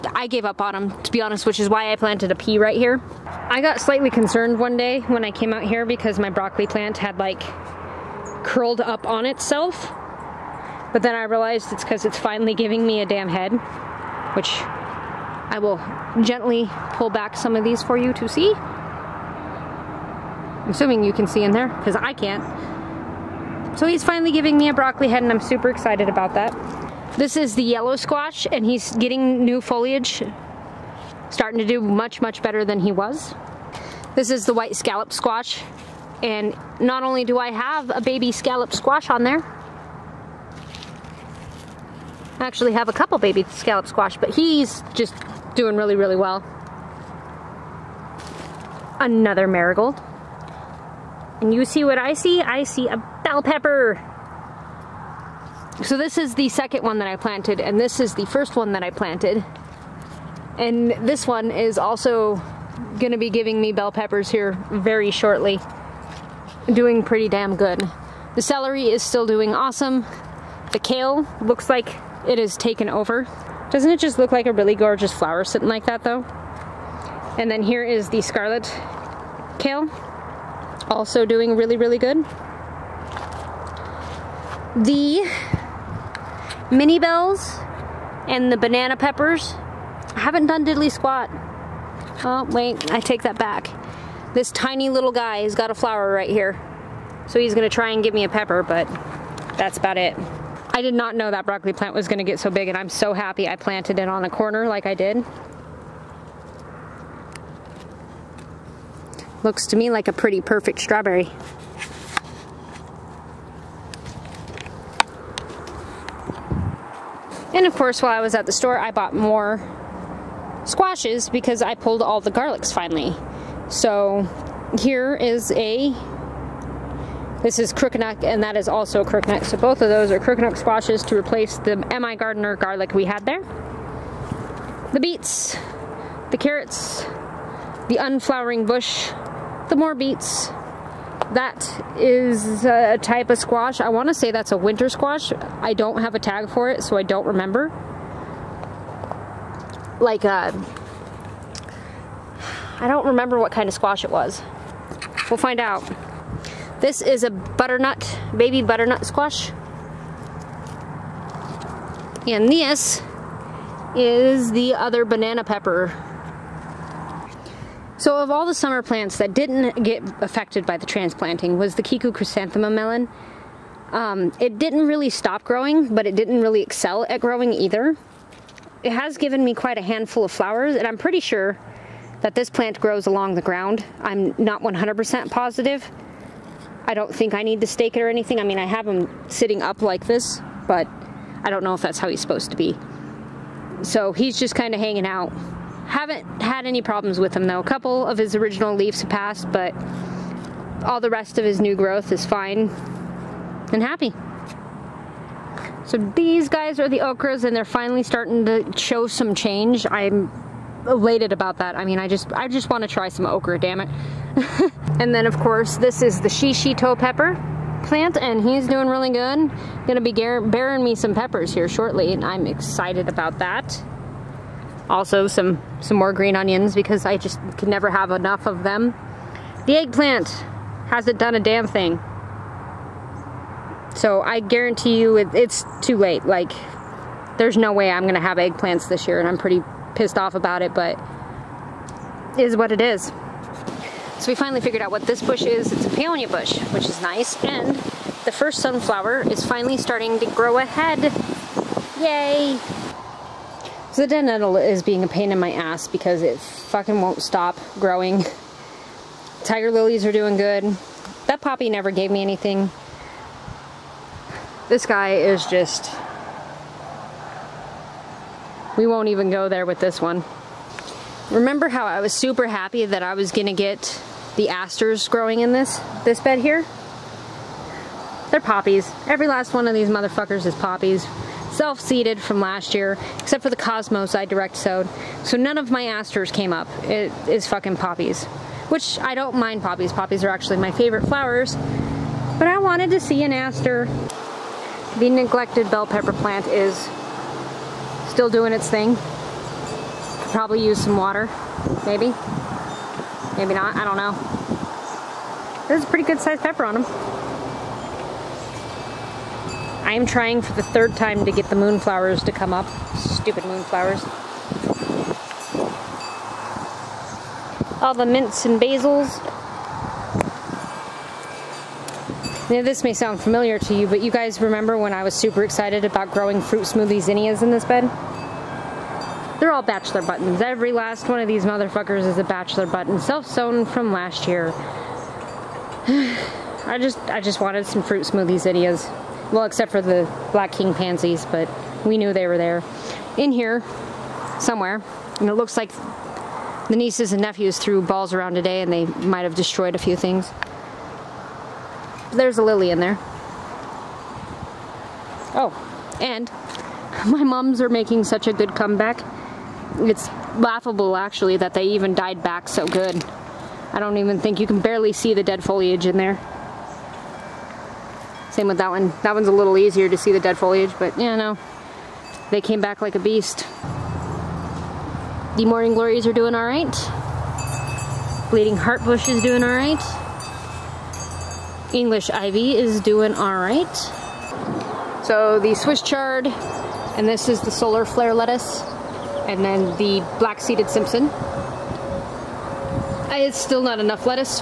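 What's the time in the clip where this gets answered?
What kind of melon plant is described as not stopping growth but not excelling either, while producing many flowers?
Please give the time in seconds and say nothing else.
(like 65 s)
171 s.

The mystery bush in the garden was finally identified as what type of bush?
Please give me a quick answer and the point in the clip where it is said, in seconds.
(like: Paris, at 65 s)
peonia bush, at 245 s.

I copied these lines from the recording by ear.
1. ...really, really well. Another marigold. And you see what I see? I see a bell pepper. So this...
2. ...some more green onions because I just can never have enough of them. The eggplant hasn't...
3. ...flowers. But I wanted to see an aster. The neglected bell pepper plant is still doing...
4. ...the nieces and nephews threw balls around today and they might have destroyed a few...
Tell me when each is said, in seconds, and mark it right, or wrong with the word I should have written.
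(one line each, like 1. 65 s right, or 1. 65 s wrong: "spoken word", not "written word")
1. 45 s right
2. 225 s right
3. 291 s right
4. 346 s right.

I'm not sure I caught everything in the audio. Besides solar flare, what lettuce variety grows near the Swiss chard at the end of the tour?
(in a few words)
black seeded Simpson.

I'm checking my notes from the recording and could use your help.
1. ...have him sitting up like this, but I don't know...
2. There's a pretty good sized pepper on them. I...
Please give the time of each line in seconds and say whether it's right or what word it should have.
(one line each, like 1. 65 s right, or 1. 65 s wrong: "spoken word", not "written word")
1. 188 s right
2. 305 s right.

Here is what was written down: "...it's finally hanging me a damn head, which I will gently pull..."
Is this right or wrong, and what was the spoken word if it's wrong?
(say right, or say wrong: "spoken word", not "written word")
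wrong: "giving", not "hanging".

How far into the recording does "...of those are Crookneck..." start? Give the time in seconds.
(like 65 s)
129 s.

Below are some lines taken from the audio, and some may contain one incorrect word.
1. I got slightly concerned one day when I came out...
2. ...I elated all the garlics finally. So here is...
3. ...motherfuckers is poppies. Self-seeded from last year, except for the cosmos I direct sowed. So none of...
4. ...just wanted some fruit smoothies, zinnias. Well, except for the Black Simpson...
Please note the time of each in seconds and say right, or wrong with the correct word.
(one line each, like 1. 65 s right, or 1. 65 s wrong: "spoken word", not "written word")
1. 3 s right
2. 121 s wrong: "pulled", not "elated"
3. 279 s right
4. 337 s wrong: "King", not "Simpson".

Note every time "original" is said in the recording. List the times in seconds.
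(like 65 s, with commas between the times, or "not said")
198 s.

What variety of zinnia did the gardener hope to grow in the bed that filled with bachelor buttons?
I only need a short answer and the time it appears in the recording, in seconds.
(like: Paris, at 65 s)
fruit smoothie, at 326 s.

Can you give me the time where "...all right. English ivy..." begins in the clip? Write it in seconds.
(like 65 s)
379 s.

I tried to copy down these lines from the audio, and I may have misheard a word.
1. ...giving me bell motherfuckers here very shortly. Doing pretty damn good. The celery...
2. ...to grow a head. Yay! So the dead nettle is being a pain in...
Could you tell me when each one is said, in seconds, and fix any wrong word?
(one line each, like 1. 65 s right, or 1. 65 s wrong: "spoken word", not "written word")
1. 63 s wrong: "peppers", not "motherfuckers"
2. 250 s right.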